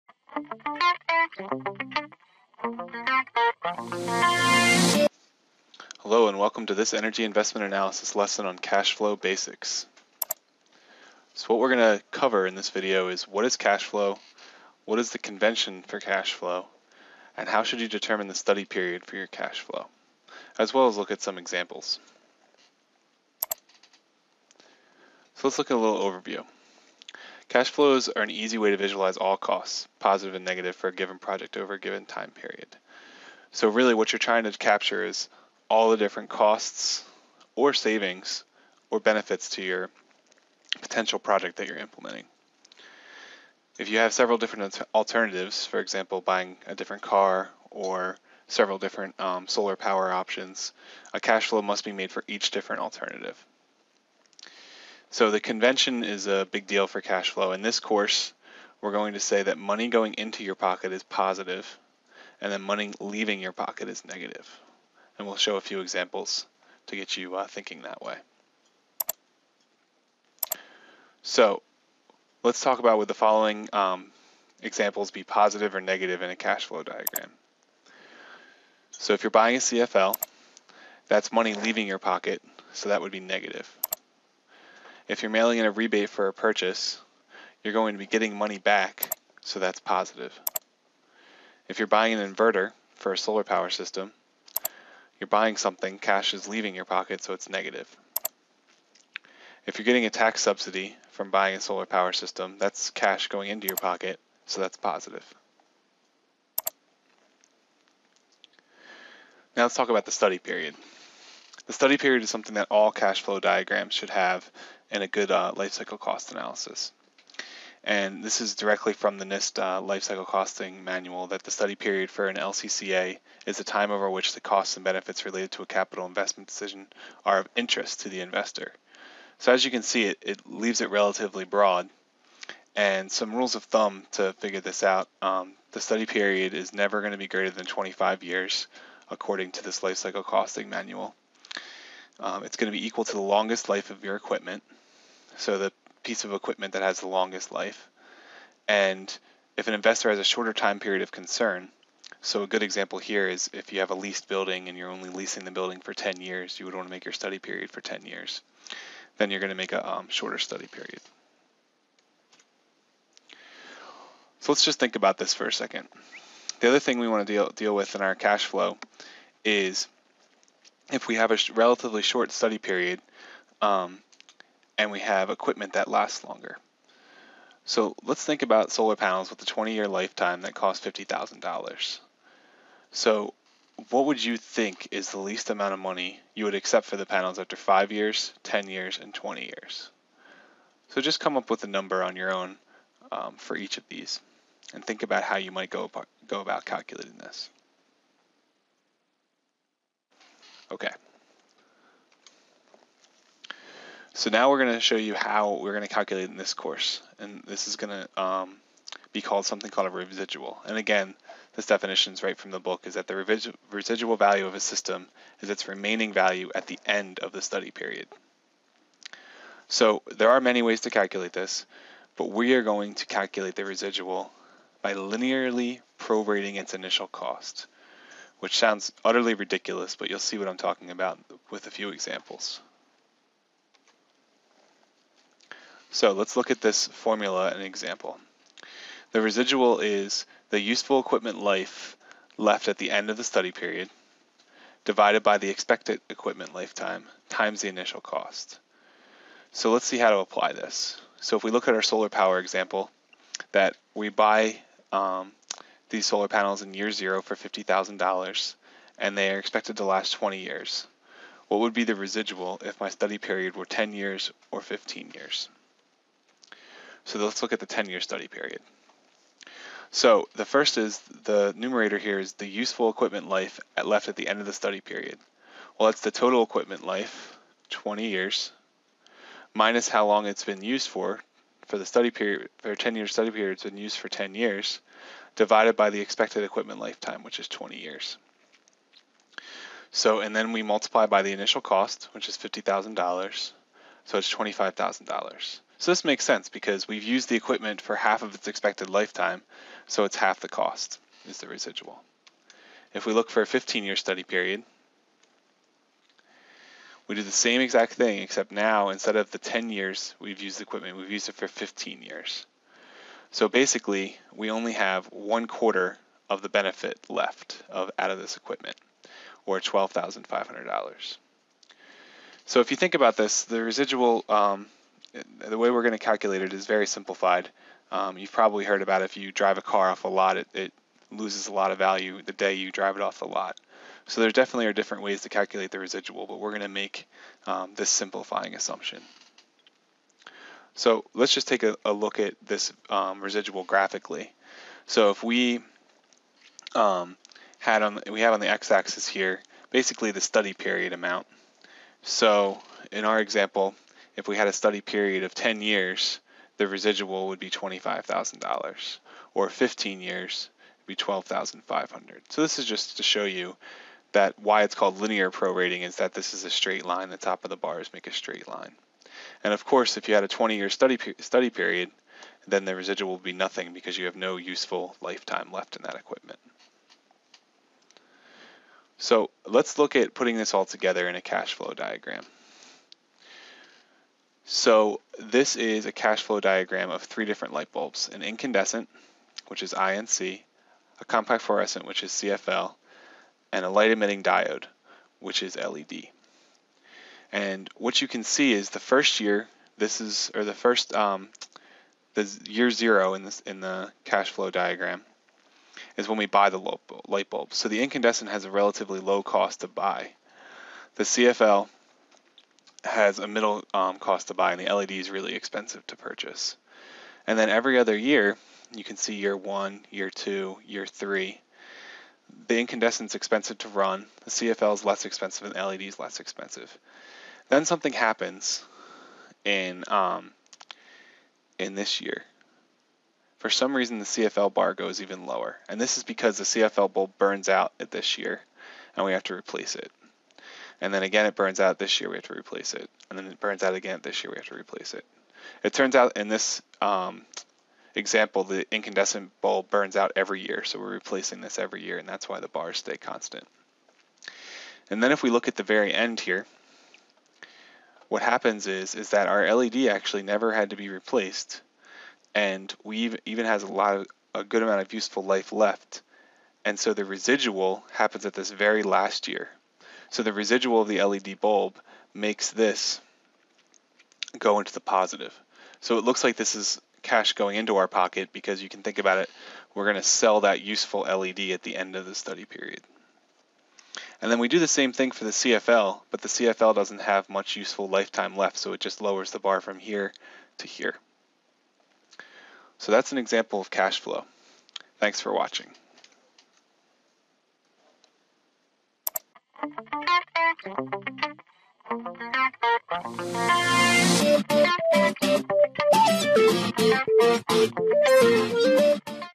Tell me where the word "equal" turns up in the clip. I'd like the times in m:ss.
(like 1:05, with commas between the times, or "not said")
2:22.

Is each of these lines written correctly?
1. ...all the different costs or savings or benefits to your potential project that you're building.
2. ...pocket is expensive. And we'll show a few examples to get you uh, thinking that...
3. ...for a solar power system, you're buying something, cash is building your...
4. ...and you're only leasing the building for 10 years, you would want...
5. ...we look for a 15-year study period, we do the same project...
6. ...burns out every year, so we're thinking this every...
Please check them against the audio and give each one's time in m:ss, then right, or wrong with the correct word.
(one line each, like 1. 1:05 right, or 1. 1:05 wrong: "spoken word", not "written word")
1. 0:35 wrong: "implementing", not "building"
2. 1:03 wrong: "negative", not "expensive"
3. 1:32 wrong: "leaving", not "building"
4. 2:34 right
5. 5:03 wrong: "exact", not "project"
6. 7:29 wrong: "replacing", not "thinking".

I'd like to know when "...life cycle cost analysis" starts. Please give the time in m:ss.
1:55.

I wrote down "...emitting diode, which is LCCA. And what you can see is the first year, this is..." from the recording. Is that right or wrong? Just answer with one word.
wrong.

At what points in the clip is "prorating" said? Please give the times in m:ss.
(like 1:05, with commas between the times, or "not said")
3:45, 6:05.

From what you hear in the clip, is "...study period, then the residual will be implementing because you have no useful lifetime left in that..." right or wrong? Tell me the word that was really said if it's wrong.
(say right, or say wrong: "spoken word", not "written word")
wrong: "nothing", not "implementing".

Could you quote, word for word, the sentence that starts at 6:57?
And then every other year, you can see year one, year two, year three.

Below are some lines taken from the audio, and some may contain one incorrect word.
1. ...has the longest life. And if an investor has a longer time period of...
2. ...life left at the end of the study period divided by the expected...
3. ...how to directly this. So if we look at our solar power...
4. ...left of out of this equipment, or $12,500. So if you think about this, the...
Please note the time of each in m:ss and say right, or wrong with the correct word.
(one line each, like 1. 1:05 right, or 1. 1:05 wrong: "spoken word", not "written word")
1. 2:26 wrong: "shorter", not "longer"
2. 4:01 right
3. 4:09 wrong: "apply", not "directly"
4. 5:17 right.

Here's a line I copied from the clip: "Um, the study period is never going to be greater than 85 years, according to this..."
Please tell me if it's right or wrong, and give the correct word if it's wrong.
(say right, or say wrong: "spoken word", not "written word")
wrong: "25", not "85".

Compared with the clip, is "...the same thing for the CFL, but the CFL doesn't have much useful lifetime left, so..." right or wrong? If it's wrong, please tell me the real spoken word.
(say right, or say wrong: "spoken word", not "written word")
right.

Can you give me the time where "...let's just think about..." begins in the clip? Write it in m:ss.
2:44.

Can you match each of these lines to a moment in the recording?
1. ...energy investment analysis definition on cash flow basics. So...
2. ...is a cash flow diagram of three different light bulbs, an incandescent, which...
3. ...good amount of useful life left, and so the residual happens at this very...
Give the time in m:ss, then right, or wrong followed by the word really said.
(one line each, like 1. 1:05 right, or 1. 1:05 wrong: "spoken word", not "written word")
1. 0:06 wrong: "lesson", not "definition"
2. 6:25 right
3. 7:44 right.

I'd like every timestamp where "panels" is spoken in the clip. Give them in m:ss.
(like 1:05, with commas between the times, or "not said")
2:58, 3:07, 4:16.